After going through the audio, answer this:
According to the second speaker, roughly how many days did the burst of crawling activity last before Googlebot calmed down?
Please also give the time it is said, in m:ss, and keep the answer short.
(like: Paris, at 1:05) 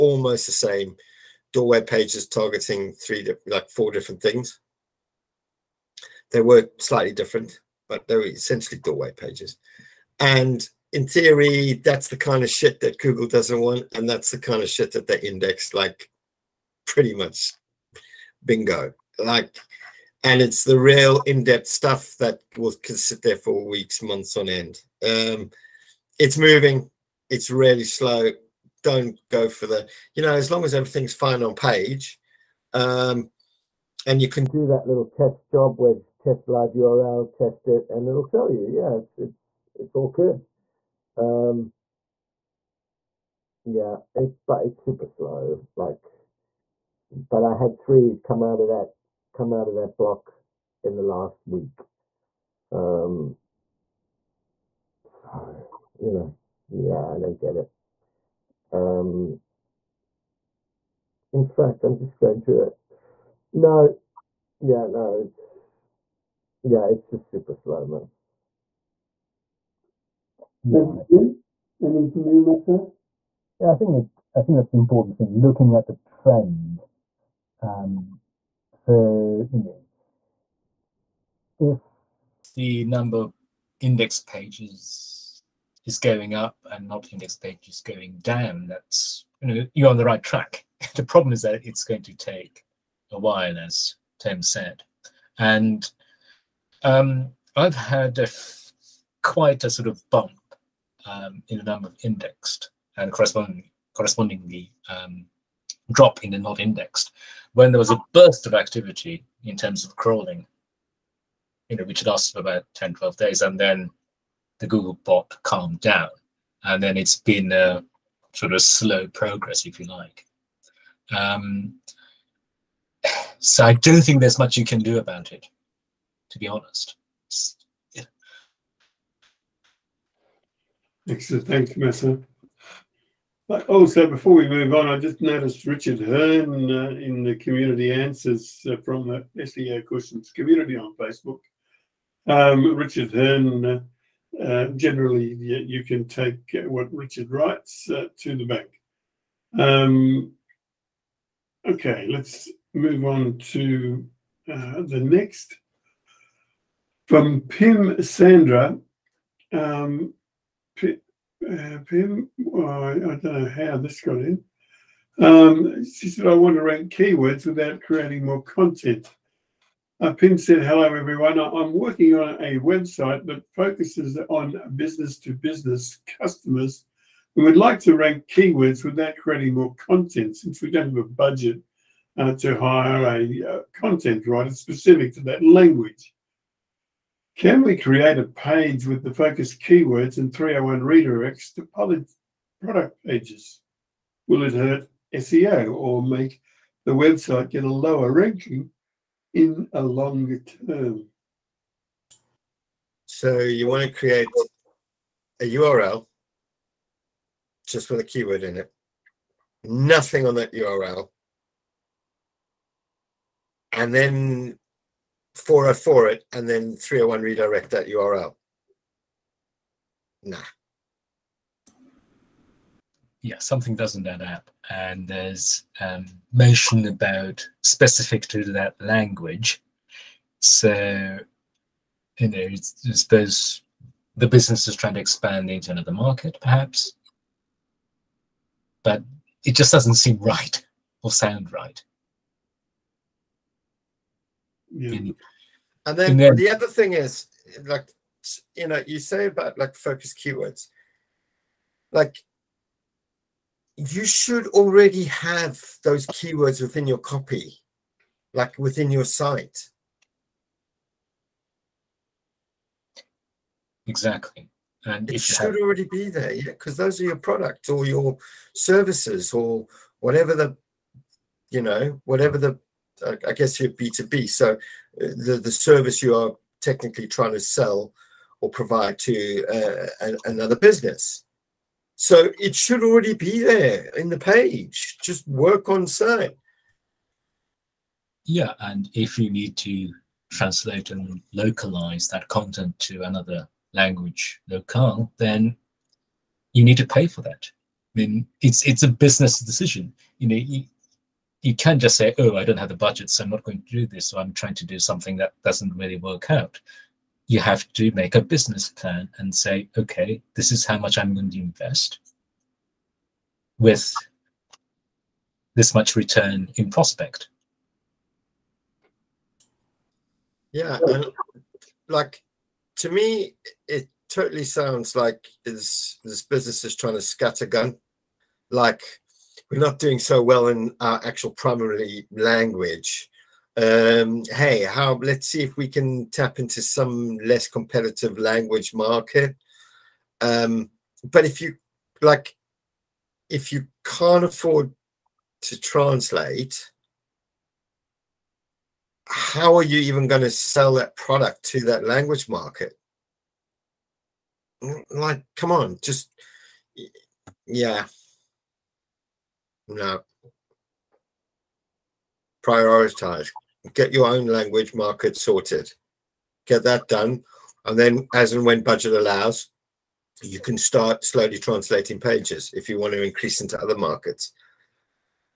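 10 to 12 days, at 1:52.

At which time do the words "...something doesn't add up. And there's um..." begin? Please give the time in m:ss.
3:43.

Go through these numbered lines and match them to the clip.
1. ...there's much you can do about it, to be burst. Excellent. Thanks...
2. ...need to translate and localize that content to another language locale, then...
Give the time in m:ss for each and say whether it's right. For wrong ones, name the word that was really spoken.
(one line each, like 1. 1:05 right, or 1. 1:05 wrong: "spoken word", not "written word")
1. 2:04 wrong: "honest", not "burst"
2. 4:49 right.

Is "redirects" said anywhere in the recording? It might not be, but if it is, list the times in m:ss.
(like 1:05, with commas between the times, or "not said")
3:10, 3:37.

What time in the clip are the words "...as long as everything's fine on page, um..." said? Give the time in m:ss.
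0:30.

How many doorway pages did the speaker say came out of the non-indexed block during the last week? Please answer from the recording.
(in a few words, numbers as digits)
3.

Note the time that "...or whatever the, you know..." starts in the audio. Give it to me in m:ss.
4:29.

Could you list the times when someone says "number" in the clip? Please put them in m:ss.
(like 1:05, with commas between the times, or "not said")
1:22, 1:41.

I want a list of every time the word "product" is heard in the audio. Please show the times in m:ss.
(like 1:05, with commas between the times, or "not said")
3:11, 4:27, 5:50.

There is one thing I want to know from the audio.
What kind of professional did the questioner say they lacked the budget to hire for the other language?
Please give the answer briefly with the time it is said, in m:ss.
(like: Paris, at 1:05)
content writer, at 3:03.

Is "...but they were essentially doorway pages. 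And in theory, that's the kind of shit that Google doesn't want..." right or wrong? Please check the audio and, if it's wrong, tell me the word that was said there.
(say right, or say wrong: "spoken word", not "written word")
right.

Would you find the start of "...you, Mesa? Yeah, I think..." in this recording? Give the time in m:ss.
1:12.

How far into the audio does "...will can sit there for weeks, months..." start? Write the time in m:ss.
0:22.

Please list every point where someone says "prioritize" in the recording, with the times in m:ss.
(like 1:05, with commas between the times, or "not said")
6:02.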